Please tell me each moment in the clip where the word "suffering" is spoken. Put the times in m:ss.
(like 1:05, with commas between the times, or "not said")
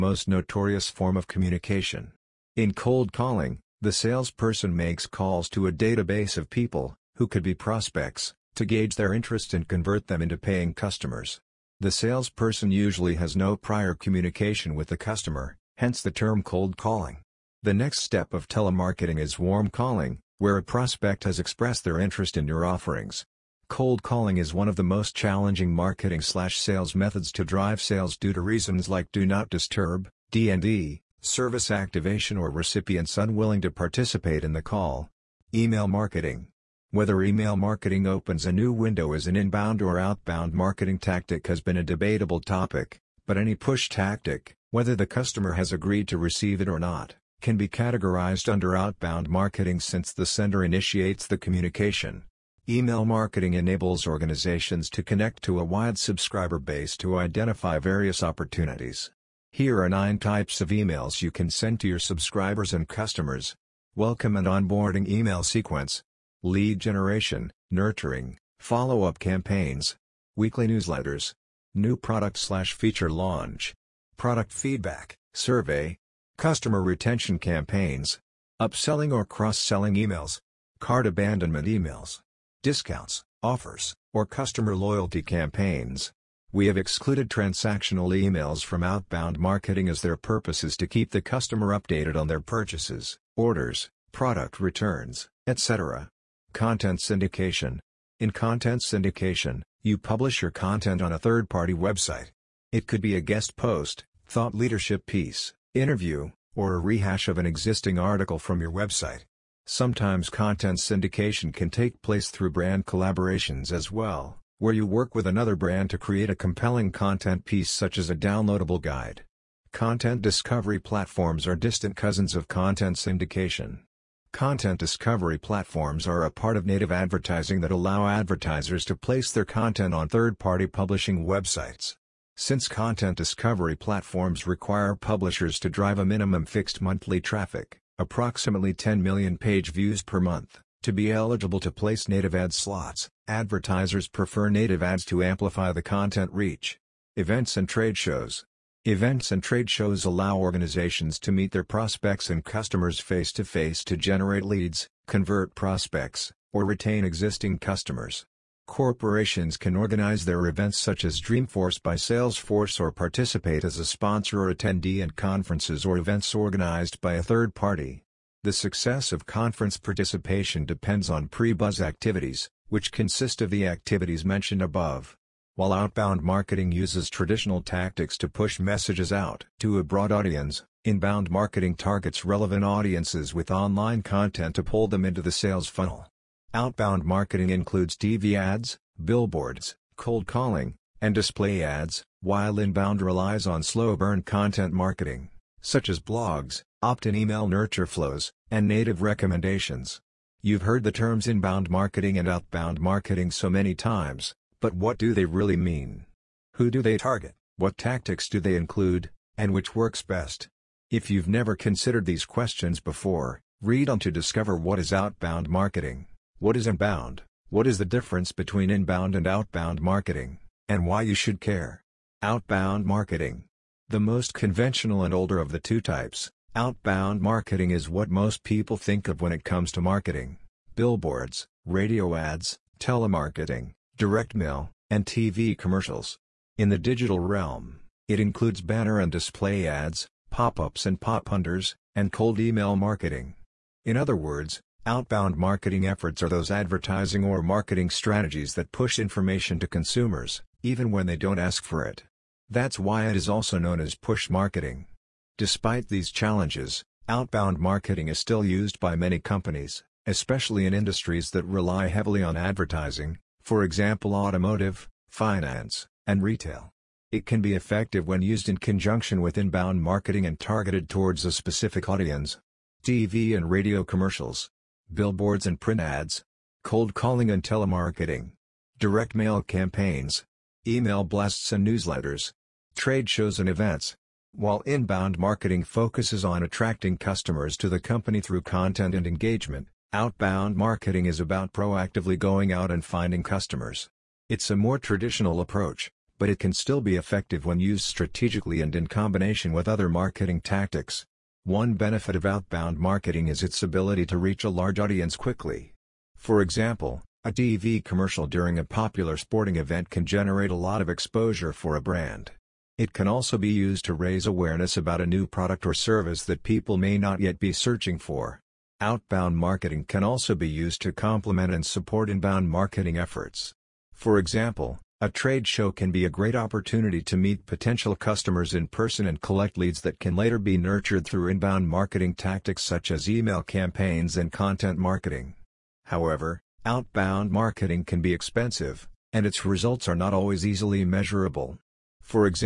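not said.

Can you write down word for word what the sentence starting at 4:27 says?
It can be effective when used in conjunction with inbound marketing and targeted towards a specific audience.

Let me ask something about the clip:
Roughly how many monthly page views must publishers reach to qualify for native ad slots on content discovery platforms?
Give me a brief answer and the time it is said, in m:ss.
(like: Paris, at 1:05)
10 million, at 2:18.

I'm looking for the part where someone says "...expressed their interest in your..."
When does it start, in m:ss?
0:21.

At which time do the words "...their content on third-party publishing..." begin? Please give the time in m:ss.
2:09.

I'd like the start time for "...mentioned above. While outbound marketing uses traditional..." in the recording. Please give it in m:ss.
2:54.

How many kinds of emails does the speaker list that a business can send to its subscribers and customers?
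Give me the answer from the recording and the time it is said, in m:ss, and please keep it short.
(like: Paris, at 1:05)
9, at 0:59.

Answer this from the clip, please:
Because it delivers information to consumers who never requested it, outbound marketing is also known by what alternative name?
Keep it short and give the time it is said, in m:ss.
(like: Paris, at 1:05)
push marketing, at 4:13.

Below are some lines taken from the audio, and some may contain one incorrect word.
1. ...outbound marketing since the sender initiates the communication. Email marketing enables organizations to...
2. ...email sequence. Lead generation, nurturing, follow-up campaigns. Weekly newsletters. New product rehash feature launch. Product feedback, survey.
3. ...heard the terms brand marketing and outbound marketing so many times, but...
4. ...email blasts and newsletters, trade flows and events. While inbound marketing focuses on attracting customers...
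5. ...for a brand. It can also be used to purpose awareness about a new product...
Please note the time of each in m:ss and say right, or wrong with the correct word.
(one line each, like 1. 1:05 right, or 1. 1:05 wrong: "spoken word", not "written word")
1. 0:48 right
2. 1:05 wrong: "slash", not "rehash"
3. 3:20 wrong: "inbound", not "brand"
4. 4:40 wrong: "shows", not "flows"
5. 5:11 wrong: "raise", not "purpose".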